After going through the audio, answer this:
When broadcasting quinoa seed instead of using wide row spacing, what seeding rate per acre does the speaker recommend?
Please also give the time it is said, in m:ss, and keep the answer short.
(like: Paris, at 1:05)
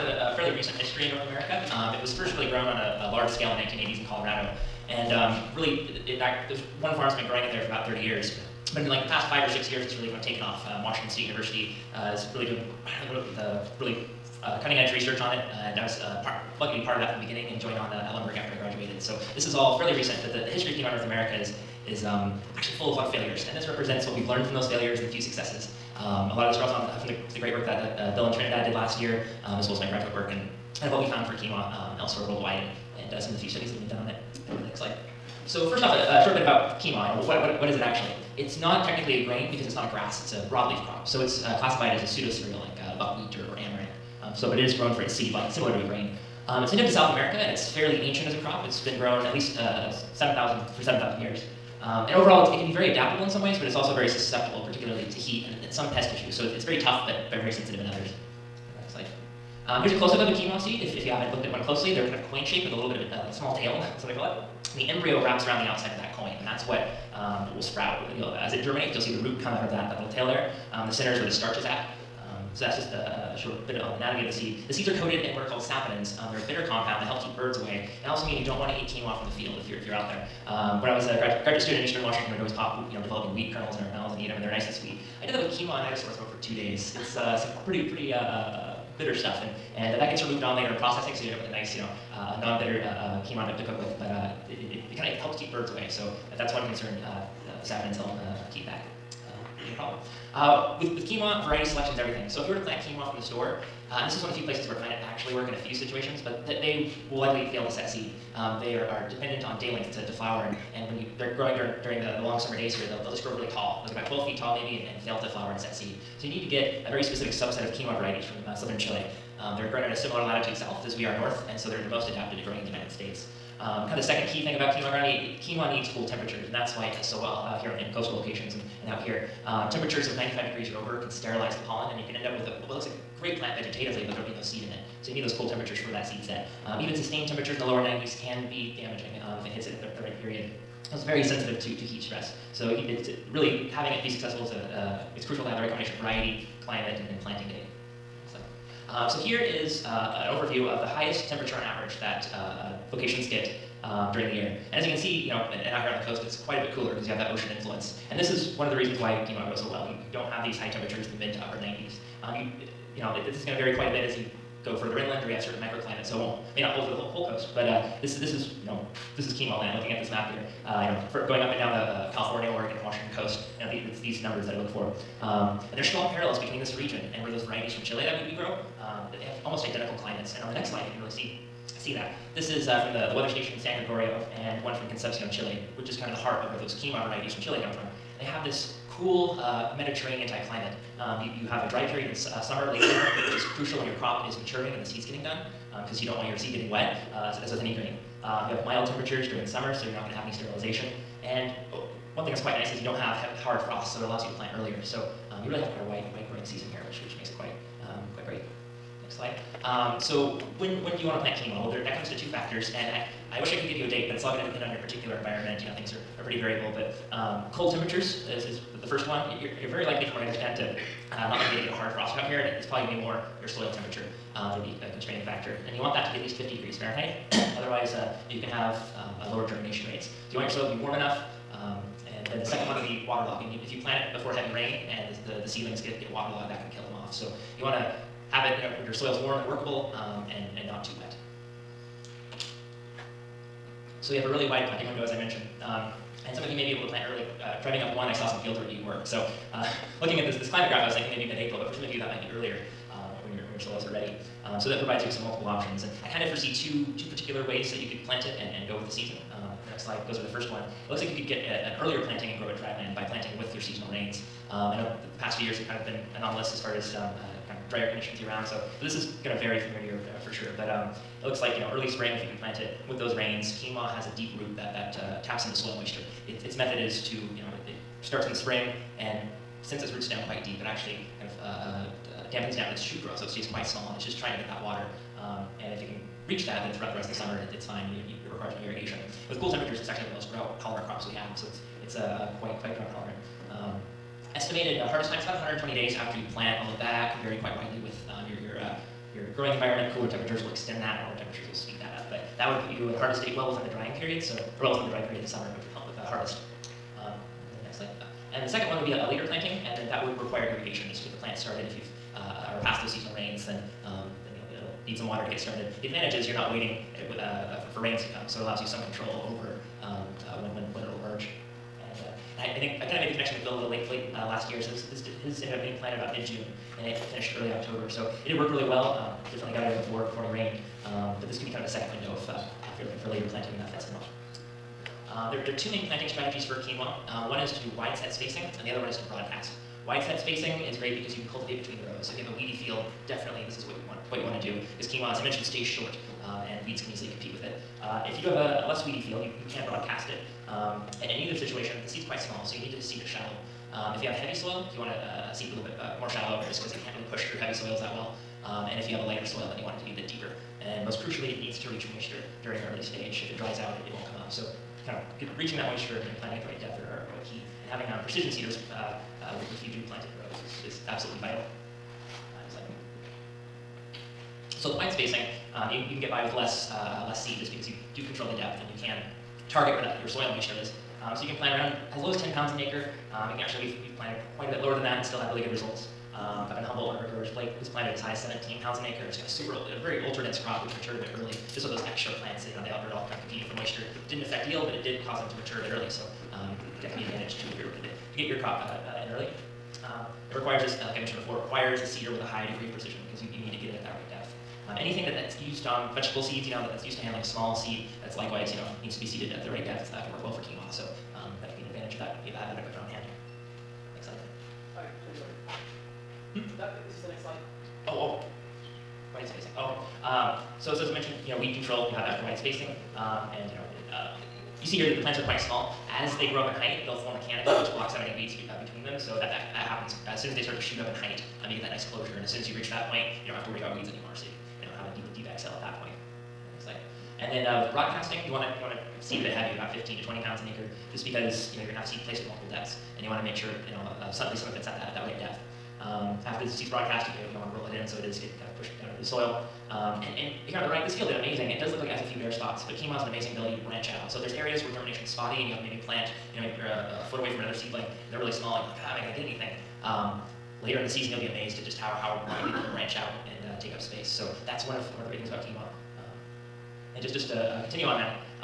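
15 to 20 pounds, at 7:19.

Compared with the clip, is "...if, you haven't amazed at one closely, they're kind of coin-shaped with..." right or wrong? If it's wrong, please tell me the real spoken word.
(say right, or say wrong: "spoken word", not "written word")
wrong: "looked", not "amazed".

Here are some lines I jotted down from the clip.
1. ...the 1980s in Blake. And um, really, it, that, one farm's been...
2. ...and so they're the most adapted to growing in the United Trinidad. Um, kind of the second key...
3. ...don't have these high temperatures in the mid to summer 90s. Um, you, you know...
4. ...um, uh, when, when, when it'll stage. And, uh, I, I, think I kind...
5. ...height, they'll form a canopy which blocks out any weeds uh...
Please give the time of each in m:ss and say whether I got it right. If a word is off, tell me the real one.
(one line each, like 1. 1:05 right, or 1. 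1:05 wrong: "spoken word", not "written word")
1. 0:03 wrong: "Colorado", not "Blake"
2. 2:01 wrong: "States", not "Trinidad"
3. 2:40 wrong: "upper", not "summer"
4. 5:19 wrong: "emerge", not "stage"
5. 7:06 right.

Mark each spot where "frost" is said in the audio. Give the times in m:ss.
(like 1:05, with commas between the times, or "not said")
3:23, 3:41.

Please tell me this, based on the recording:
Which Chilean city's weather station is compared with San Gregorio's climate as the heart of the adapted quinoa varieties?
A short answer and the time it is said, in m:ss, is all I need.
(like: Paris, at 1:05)
Concepcion, at 3:04.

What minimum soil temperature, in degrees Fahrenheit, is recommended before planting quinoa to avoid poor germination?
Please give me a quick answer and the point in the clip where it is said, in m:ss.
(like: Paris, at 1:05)
50, at 3:46.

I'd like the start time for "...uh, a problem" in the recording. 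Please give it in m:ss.
1:39.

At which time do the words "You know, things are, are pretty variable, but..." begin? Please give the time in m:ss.
3:35.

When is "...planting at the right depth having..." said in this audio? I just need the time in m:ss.
6:06.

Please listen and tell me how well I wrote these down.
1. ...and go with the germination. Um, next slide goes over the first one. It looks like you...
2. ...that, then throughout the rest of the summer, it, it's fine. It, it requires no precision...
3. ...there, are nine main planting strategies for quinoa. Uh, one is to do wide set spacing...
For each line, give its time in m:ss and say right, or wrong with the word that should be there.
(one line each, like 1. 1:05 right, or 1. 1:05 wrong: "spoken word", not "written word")
1. 4:18 wrong: "season", not "germination"
2. 4:46 wrong: "irrigation", not "precision"
3. 5:35 wrong: "two", not "nine".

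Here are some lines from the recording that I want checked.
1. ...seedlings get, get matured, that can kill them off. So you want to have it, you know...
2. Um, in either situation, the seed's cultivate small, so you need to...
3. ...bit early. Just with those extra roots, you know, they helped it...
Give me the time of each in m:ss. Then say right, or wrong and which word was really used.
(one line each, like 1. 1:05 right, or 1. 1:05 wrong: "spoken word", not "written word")
1. 3:55 wrong: "waterlogged", not "matured"
2. 5:50 wrong: "quite", not "cultivate"
3. 6:31 wrong: "plants", not "roots".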